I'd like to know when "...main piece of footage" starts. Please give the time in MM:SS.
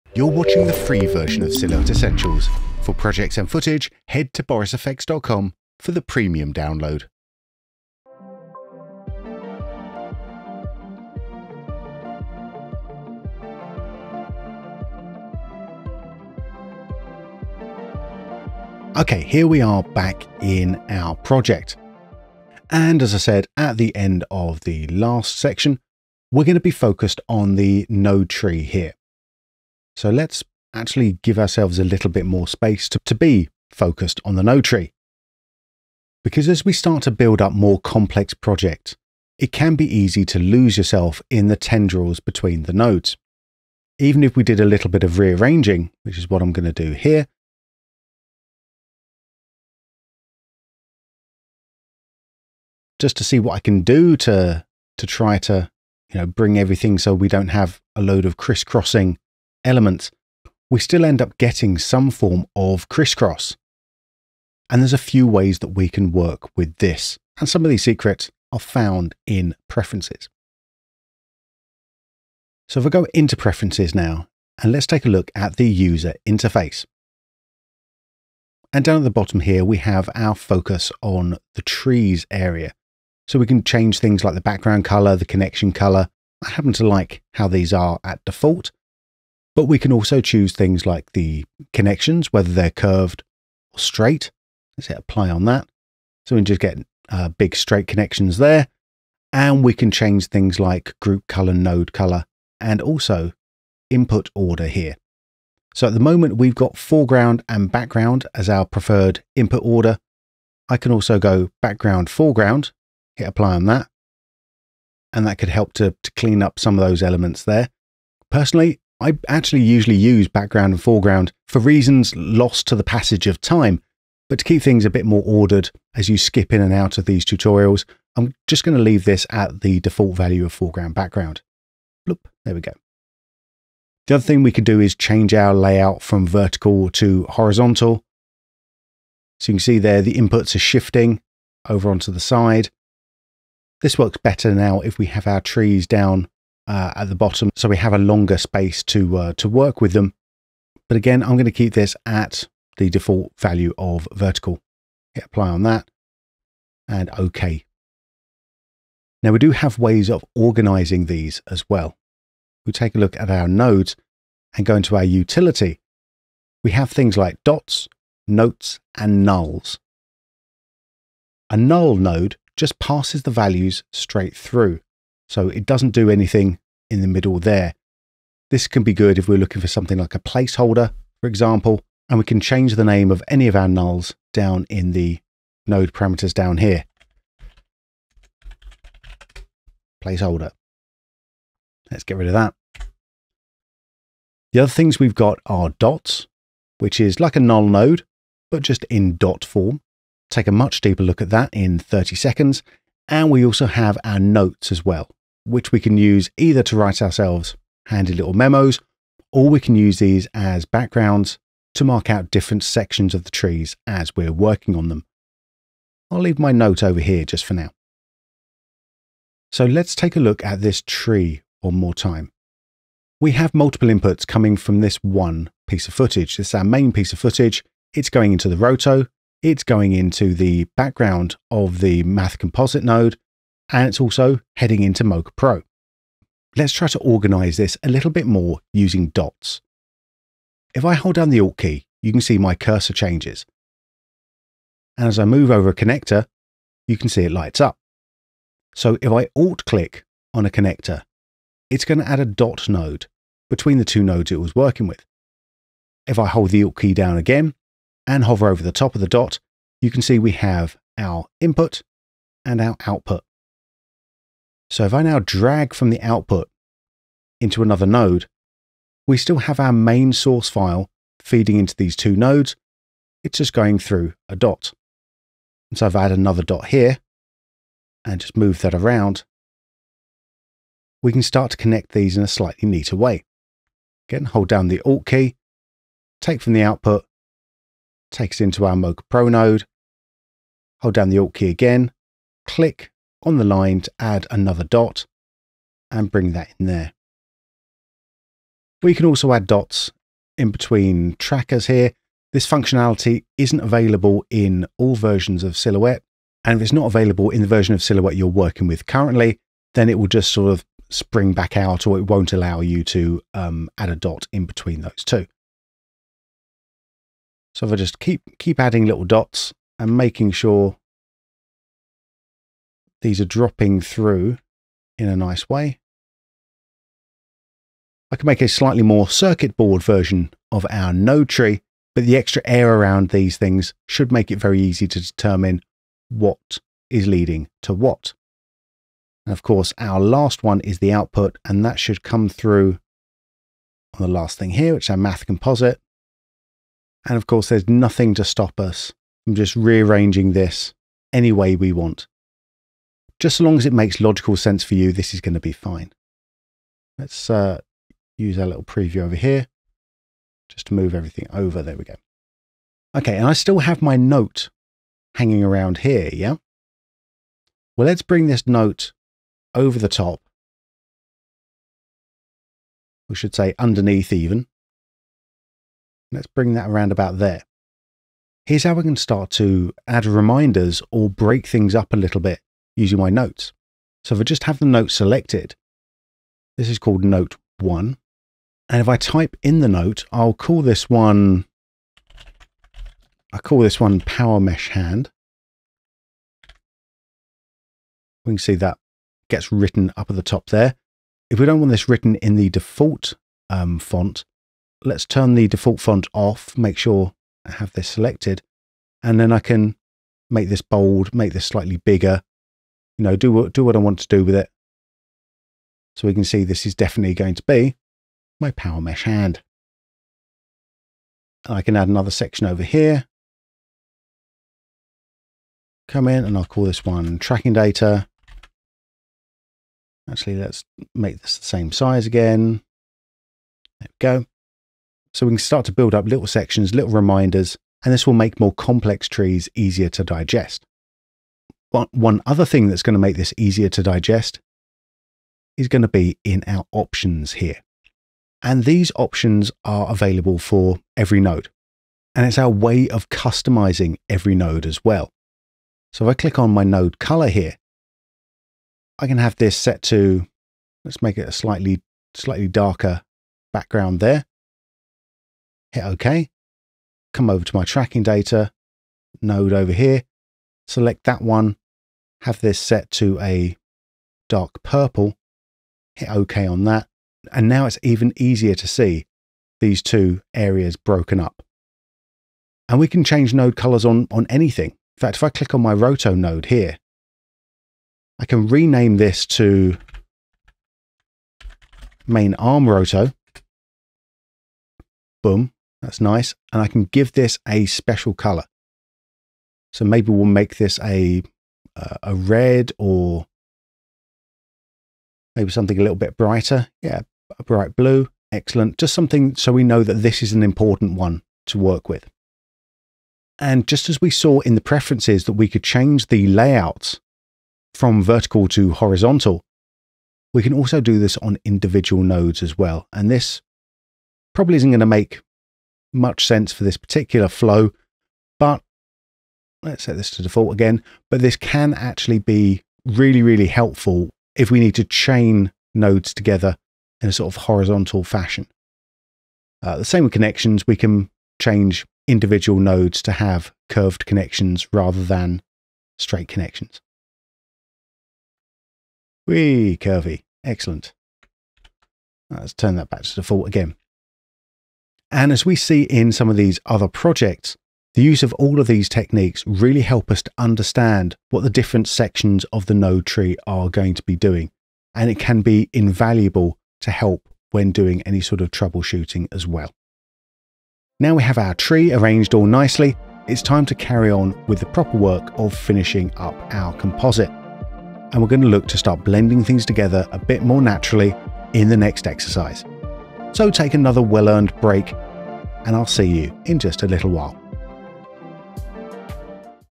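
03:46.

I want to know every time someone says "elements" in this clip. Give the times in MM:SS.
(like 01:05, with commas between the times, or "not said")
00:59, 01:57.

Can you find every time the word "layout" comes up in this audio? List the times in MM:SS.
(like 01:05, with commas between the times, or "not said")
02:15, 08:36.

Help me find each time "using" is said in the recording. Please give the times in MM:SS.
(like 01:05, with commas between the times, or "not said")
03:58, 06:22.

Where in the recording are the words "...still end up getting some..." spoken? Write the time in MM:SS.
01:00.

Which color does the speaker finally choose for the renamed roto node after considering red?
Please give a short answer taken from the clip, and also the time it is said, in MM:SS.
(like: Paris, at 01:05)
bright blue, at 08:27.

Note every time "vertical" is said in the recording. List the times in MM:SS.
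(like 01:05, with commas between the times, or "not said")
02:16, 02:34, 08:38.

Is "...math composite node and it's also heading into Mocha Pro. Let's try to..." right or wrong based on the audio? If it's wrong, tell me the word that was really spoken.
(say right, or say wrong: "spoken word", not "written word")
right.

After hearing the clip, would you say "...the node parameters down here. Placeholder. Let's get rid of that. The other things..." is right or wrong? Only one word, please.
right.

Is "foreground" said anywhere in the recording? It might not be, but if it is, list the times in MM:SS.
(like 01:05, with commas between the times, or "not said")
01:46, 01:52, 02:00, 02:10.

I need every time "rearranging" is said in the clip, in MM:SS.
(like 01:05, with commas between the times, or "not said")
00:45, 05:49.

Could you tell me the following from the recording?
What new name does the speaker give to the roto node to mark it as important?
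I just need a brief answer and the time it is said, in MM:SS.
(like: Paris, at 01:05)
main arm roto, at 08:12.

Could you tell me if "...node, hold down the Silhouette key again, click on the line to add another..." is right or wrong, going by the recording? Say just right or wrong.
wrong.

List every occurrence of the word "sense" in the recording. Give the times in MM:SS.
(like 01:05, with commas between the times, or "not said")
05:54, 08:46.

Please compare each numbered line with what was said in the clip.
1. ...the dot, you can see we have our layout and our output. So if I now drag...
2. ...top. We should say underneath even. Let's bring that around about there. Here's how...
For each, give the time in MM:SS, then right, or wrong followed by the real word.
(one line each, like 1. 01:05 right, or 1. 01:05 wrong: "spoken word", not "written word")
1. 04:19 wrong: "input", not "layout"
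2. 06:09 right.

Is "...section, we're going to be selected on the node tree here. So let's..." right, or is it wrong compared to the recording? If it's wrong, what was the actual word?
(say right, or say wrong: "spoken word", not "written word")
wrong: "focused", not "selected".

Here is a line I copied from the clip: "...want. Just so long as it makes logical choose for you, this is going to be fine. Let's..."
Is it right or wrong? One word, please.
wrong.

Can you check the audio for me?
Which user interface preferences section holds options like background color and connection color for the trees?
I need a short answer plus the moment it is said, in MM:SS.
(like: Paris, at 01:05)
focus on the trees, at 01:20.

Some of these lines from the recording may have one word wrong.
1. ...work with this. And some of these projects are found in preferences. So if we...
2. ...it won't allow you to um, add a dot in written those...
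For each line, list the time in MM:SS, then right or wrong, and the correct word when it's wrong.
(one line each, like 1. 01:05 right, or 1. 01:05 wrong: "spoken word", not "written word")
1. 01:06 wrong: "secrets", not "projects"
2. 05:11 wrong: "between", not "written".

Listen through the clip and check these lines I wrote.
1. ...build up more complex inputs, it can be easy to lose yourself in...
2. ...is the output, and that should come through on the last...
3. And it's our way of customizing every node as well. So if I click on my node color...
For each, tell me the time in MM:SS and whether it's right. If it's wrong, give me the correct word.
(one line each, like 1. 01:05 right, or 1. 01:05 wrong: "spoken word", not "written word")
1. 00:37 wrong: "projects", not "inputs"
2. 05:40 right
3. 07:32 right.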